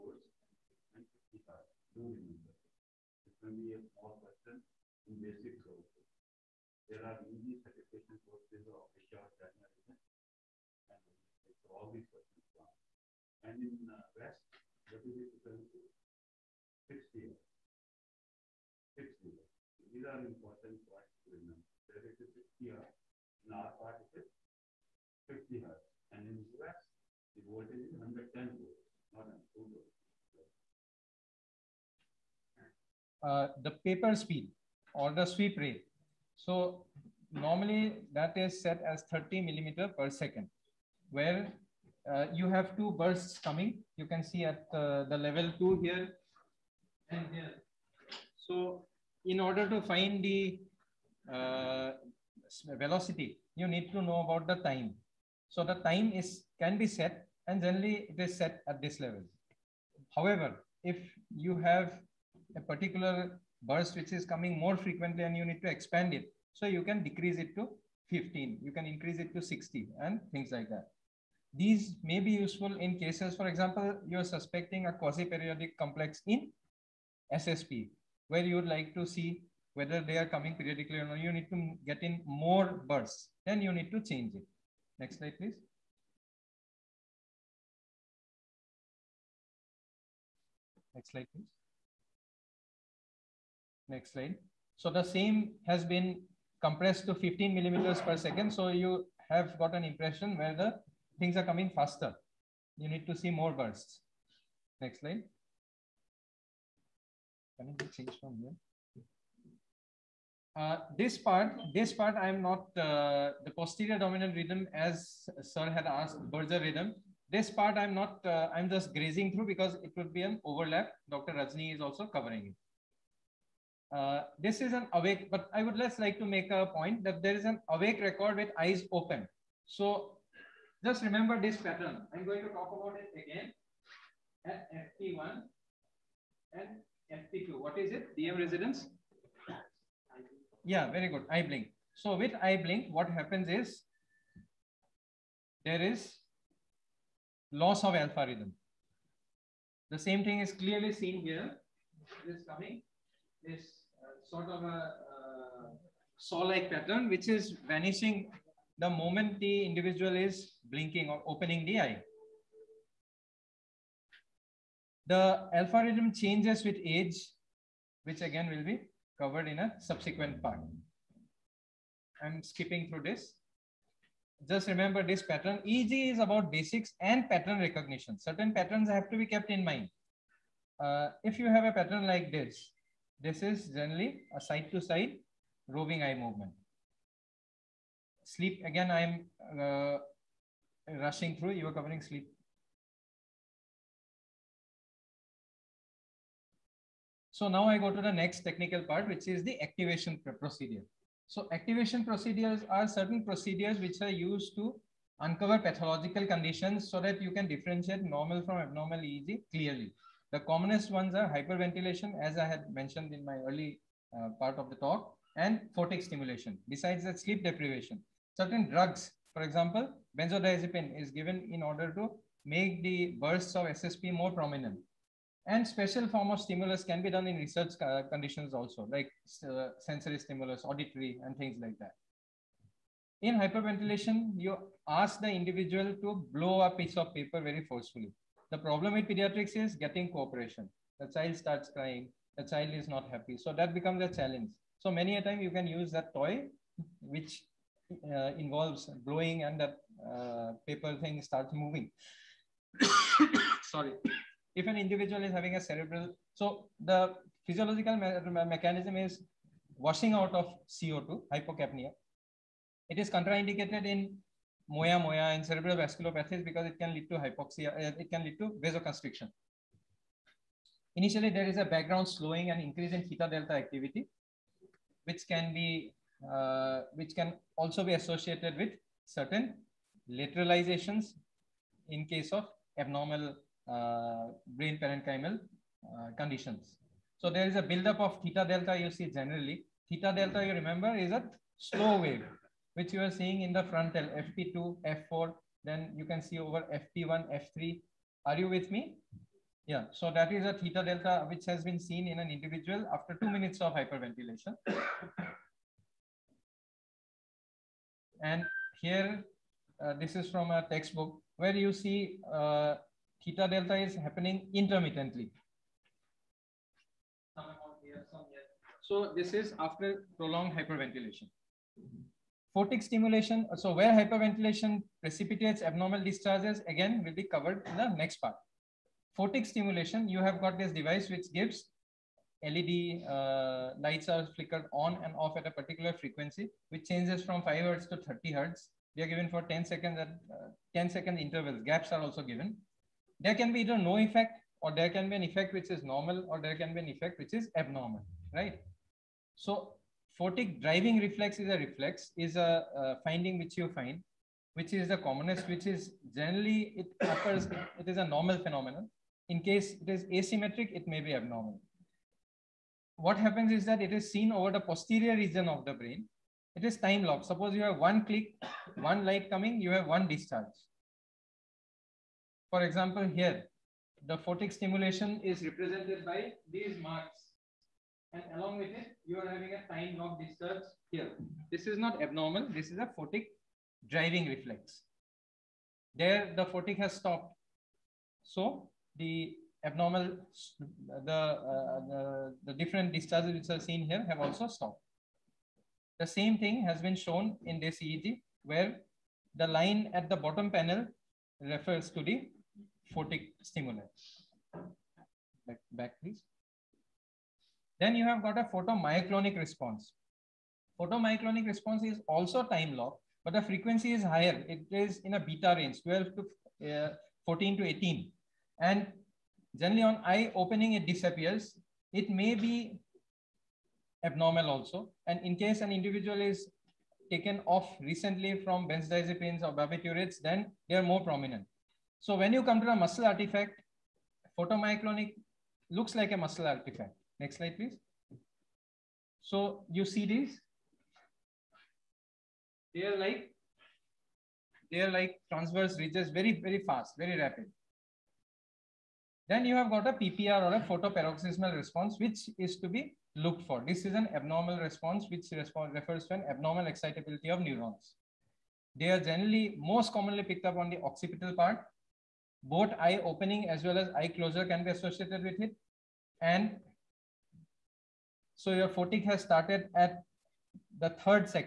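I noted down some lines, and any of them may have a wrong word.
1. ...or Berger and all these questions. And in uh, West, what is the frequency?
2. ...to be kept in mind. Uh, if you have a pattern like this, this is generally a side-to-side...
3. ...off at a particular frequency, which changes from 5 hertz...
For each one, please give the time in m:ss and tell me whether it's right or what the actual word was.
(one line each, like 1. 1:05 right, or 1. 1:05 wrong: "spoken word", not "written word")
1. 0:09 wrong: "China", not "Berger"
2. 2:59 right
3. 5:35 right.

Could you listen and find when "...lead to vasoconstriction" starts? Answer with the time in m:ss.
4:28.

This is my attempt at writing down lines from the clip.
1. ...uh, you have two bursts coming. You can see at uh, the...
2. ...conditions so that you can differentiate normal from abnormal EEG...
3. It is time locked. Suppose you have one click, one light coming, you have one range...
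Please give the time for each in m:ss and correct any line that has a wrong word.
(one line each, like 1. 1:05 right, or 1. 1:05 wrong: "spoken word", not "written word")
1. 0:42 right
2. 3:26 right
3. 6:06 wrong: "discharge", not "range".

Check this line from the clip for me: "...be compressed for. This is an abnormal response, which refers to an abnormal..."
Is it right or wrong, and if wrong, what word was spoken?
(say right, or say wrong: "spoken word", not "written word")
wrong: "looked", not "compressed".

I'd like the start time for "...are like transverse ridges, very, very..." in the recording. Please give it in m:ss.
7:24.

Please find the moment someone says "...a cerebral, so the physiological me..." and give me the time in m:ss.
4:15.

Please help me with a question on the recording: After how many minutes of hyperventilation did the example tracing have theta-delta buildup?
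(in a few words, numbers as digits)
2.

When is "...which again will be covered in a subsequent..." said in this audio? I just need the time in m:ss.
2:48.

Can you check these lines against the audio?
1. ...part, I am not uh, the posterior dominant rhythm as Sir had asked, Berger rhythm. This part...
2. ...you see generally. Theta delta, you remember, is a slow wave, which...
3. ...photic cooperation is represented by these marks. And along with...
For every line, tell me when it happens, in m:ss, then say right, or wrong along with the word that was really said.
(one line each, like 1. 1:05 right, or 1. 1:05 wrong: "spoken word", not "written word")
1. 1:51 right
2. 4:48 right
3. 6:14 wrong: "stimulation", not "cooperation".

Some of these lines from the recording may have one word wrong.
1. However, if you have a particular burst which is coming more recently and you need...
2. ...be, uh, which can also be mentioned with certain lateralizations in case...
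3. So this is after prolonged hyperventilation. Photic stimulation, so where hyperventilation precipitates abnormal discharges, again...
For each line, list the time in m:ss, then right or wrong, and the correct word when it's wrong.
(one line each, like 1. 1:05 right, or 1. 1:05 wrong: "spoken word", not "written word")
1. 1:00 wrong: "frequently", not "recently"
2. 4:35 wrong: "associated", not "mentioned"
3. 5:18 right.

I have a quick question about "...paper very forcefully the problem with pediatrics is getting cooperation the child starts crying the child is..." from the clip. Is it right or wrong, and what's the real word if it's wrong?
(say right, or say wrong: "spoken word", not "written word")
right.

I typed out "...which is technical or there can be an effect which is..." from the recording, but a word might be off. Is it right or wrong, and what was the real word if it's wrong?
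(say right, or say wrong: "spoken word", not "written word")
wrong: "normal", not "technical".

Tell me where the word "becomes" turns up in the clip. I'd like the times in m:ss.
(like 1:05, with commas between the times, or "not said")
4:03.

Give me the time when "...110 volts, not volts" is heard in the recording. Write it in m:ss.
0:27.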